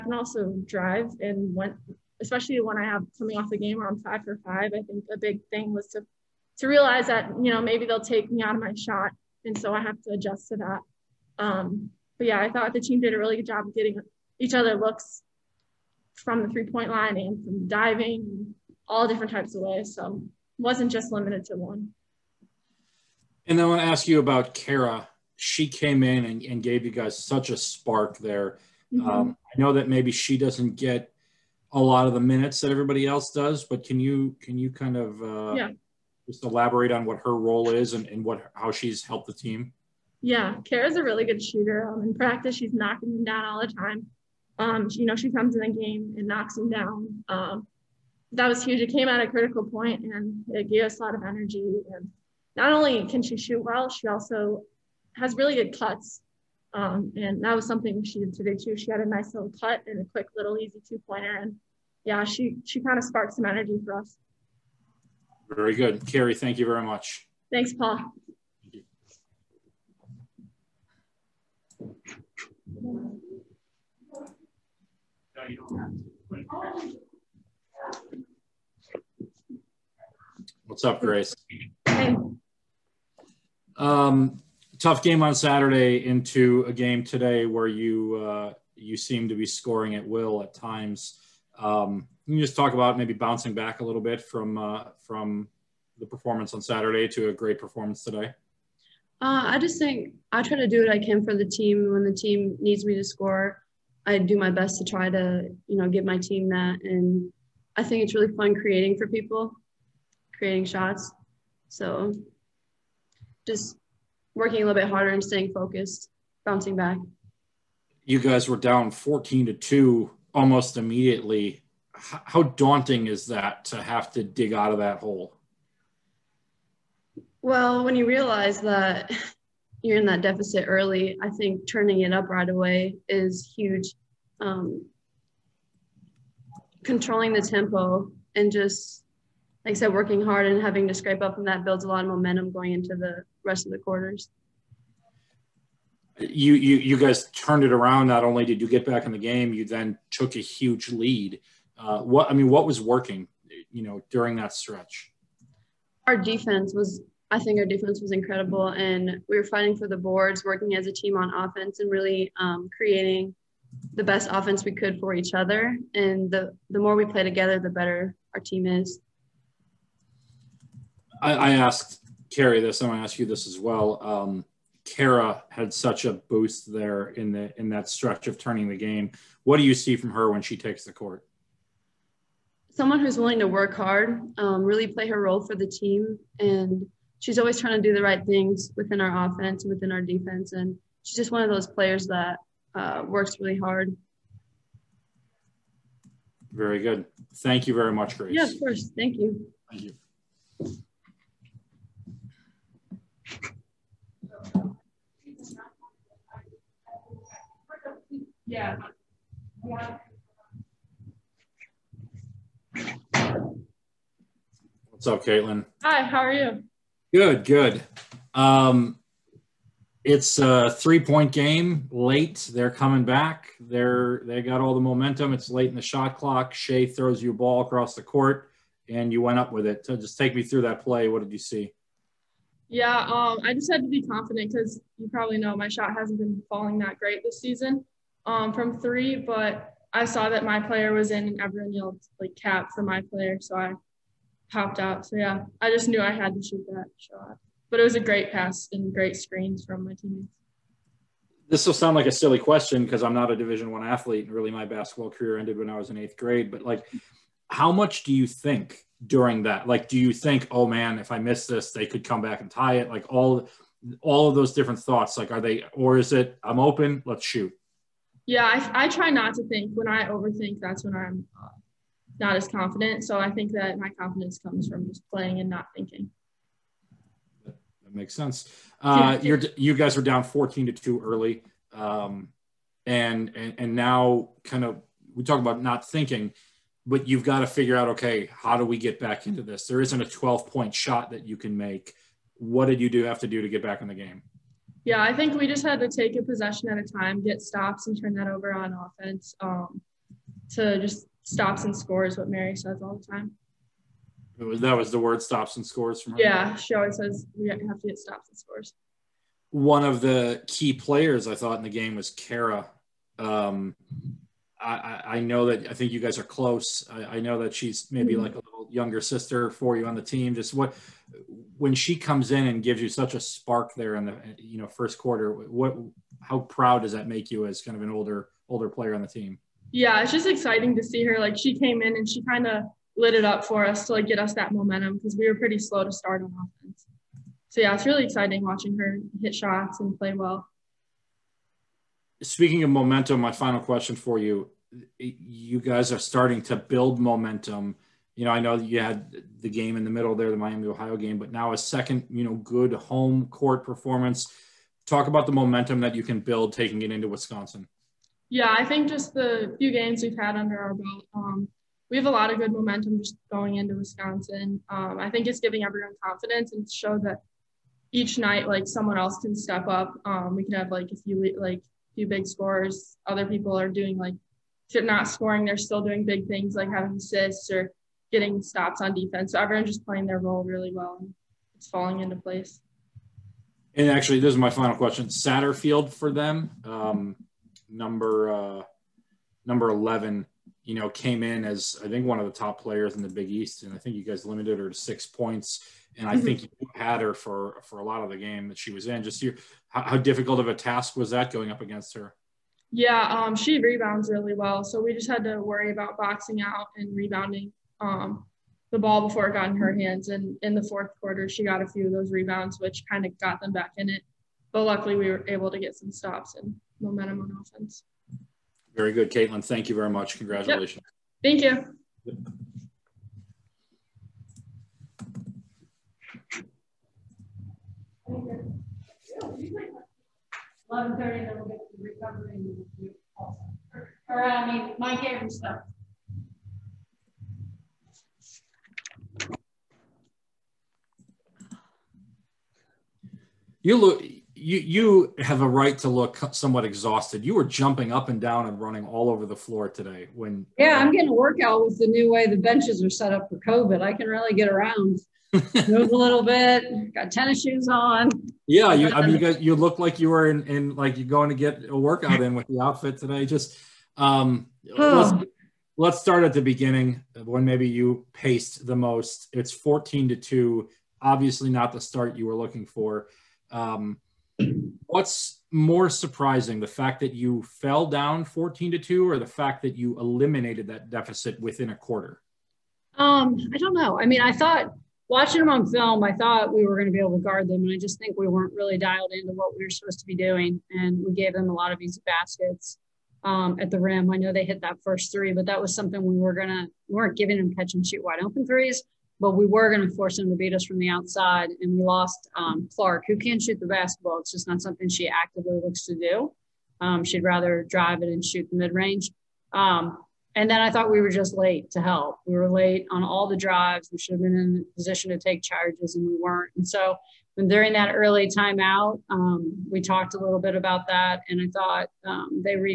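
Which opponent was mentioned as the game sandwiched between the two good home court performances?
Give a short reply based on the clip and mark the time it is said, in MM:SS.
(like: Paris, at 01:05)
Miami Ohio, at 05:50.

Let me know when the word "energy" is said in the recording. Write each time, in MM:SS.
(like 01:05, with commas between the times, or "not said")
00:51, 01:03.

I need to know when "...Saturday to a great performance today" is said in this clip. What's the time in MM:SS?
01:36.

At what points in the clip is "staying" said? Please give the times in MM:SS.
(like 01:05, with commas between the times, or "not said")
01:55.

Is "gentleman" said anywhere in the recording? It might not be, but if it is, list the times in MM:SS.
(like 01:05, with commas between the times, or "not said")
not said.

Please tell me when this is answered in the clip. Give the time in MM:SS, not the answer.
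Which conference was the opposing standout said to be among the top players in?
06:33.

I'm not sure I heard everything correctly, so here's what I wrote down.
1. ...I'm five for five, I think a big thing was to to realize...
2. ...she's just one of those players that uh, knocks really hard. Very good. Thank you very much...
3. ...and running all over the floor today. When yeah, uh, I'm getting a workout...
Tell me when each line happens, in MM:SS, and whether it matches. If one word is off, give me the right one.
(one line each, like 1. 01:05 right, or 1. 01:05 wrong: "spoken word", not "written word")
1. 00:03 right
2. 03:11 wrong: "works", not "knocks"
3. 07:28 right.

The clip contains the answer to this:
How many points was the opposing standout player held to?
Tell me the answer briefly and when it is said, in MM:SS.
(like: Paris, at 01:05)
6, at 06:34.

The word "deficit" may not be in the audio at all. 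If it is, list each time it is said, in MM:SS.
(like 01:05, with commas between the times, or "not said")
02:10, 08:00.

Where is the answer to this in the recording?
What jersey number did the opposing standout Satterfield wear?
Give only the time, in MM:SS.
06:29.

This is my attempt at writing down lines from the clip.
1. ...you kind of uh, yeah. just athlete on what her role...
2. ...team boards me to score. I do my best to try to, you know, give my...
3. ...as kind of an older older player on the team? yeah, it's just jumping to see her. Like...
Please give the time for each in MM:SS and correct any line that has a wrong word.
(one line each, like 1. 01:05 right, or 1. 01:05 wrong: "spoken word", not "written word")
1. 00:34 wrong: "elaborate", not "athlete"
2. 01:42 wrong: "needs", not "boards"
3. 05:27 wrong: "exciting", not "jumping".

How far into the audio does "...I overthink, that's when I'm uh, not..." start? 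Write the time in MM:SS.
04:29.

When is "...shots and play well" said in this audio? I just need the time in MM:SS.
05:39.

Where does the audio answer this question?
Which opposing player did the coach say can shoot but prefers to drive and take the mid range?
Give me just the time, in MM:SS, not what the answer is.
08:22.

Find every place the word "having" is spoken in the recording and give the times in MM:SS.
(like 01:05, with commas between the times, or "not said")
02:20, 06:16.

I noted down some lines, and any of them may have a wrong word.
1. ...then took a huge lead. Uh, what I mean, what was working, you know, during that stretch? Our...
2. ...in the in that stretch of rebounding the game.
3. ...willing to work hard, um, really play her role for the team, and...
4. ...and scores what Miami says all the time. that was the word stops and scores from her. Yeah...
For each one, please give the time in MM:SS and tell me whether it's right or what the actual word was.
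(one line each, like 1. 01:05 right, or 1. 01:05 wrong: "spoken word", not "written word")
1. 02:29 right
2. 02:57 wrong: "turning", not "rebounding"
3. 03:03 right
4. 05:01 wrong: "Mary", not "Miami".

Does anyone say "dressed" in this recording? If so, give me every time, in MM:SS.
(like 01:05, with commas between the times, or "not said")
not said.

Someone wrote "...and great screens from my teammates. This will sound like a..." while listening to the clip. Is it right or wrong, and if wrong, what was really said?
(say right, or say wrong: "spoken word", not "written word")
right.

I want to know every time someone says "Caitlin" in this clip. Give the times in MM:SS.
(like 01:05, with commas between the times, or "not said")
03:35, 06:59.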